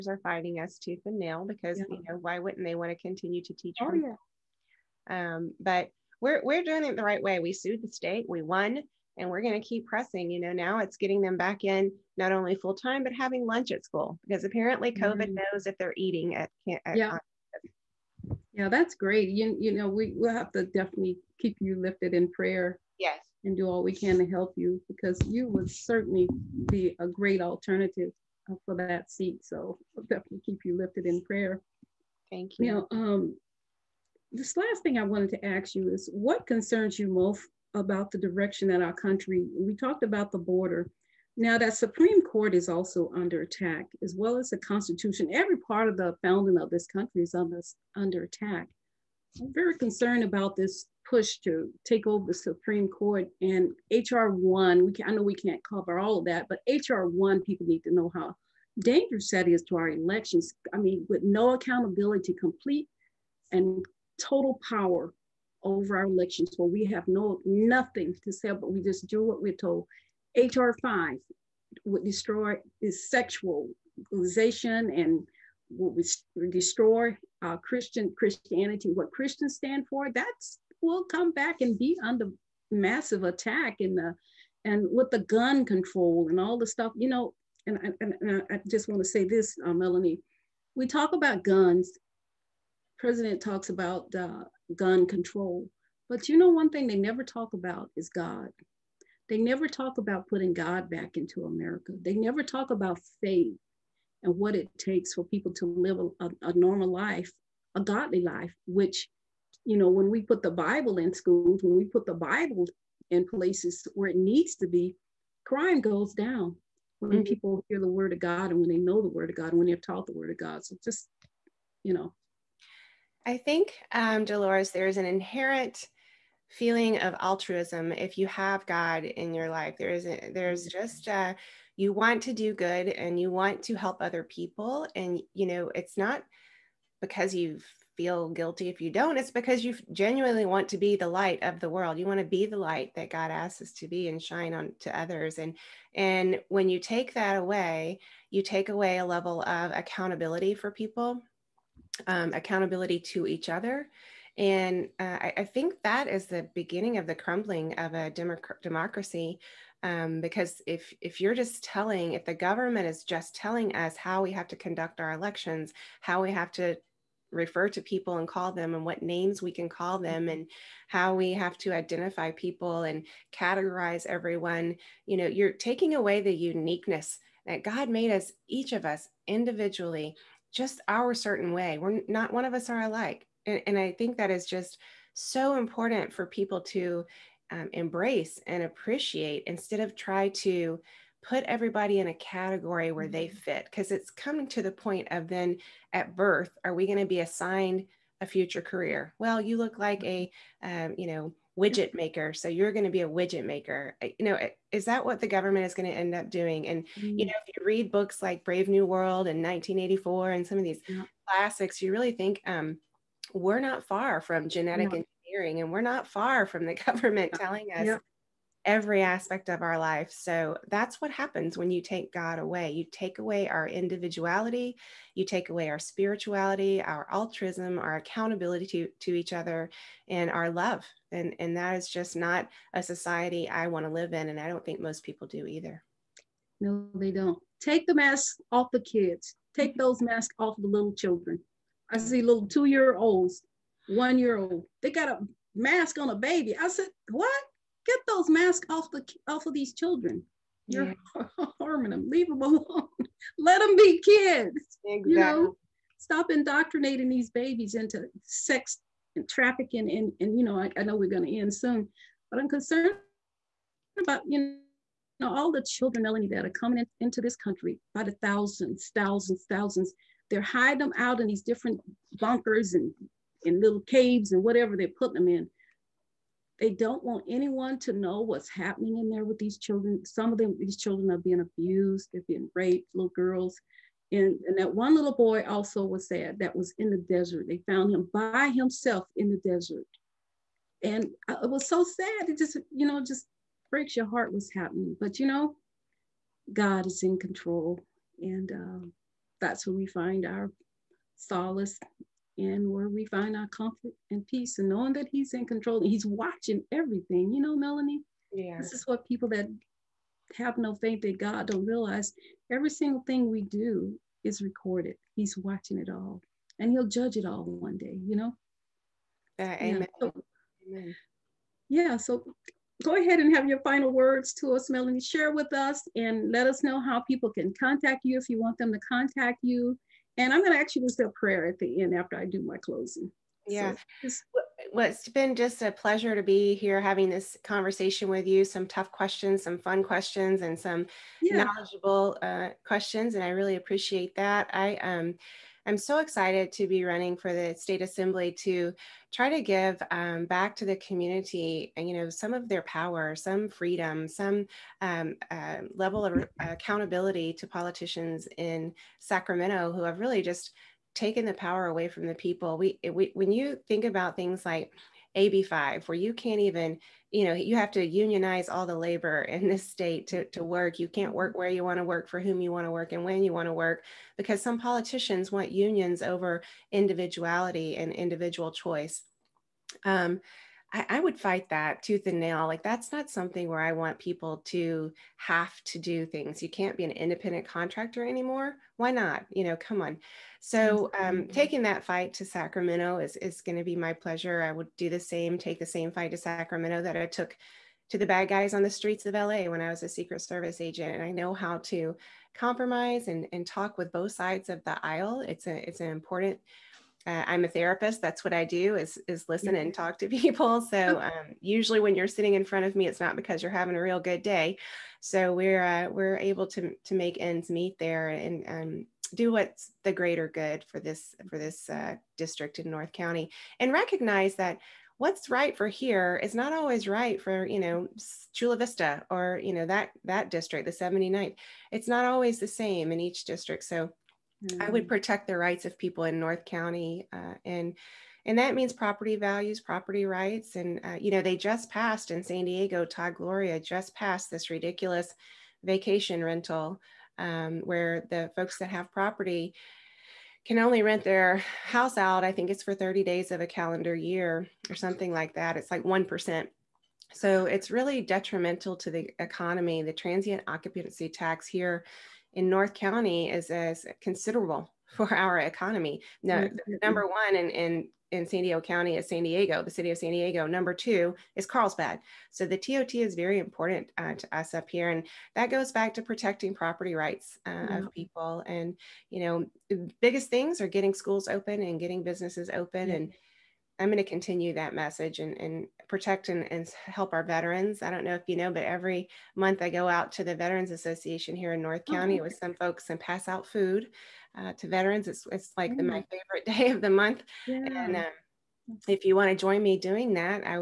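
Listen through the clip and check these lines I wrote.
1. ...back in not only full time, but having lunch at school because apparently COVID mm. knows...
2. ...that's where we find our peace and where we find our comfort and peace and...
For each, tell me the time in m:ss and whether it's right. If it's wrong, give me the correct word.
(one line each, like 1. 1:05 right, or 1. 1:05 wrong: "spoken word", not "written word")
1. 0:11 right
2. 4:59 wrong: "solace", not "peace".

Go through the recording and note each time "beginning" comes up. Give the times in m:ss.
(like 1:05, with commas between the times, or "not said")
2:36.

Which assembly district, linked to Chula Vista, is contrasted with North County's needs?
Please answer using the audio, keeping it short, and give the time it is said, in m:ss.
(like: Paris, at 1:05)
79th, at 7:10.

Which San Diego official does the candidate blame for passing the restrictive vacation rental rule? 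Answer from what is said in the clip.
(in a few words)
Todd Gloria.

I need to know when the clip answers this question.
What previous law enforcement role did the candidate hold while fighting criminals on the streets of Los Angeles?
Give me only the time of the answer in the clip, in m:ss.
6:39.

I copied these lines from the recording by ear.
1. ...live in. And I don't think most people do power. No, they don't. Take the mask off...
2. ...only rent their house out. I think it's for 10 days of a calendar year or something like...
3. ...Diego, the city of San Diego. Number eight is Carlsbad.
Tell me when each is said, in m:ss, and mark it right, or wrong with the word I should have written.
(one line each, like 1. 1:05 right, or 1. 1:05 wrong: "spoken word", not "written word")
1. 3:53 wrong: "either", not "power"
2. 7:30 wrong: "30", not "10"
3. 7:49 wrong: "two", not "eight".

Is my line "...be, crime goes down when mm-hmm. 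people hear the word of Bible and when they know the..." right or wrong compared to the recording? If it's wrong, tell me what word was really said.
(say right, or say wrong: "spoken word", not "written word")
wrong: "God", not "Bible".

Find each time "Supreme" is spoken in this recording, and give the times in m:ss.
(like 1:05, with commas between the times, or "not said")
0:41, 0:52.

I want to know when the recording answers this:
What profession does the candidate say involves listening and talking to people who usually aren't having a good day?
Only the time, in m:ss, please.
6:47.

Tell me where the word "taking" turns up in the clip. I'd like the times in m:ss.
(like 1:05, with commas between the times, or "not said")
2:55, 6:31.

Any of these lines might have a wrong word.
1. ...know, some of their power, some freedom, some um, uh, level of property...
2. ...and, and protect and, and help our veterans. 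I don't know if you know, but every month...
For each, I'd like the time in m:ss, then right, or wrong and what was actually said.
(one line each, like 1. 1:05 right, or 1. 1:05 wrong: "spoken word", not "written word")
1. 5:51 wrong: "accountability", not "property"
2. 8:05 right.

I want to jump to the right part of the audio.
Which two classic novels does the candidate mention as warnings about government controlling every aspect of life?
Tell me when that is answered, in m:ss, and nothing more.
3:28.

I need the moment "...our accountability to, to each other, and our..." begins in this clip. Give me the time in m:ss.
3:47.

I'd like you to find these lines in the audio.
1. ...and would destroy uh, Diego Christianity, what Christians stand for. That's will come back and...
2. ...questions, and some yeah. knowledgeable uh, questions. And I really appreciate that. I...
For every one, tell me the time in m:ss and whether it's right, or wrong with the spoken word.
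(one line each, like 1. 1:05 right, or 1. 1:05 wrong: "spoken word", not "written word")
1. 1:14 wrong: "Christian", not "Diego"
2. 5:39 right.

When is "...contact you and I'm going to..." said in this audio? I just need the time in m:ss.
5:28.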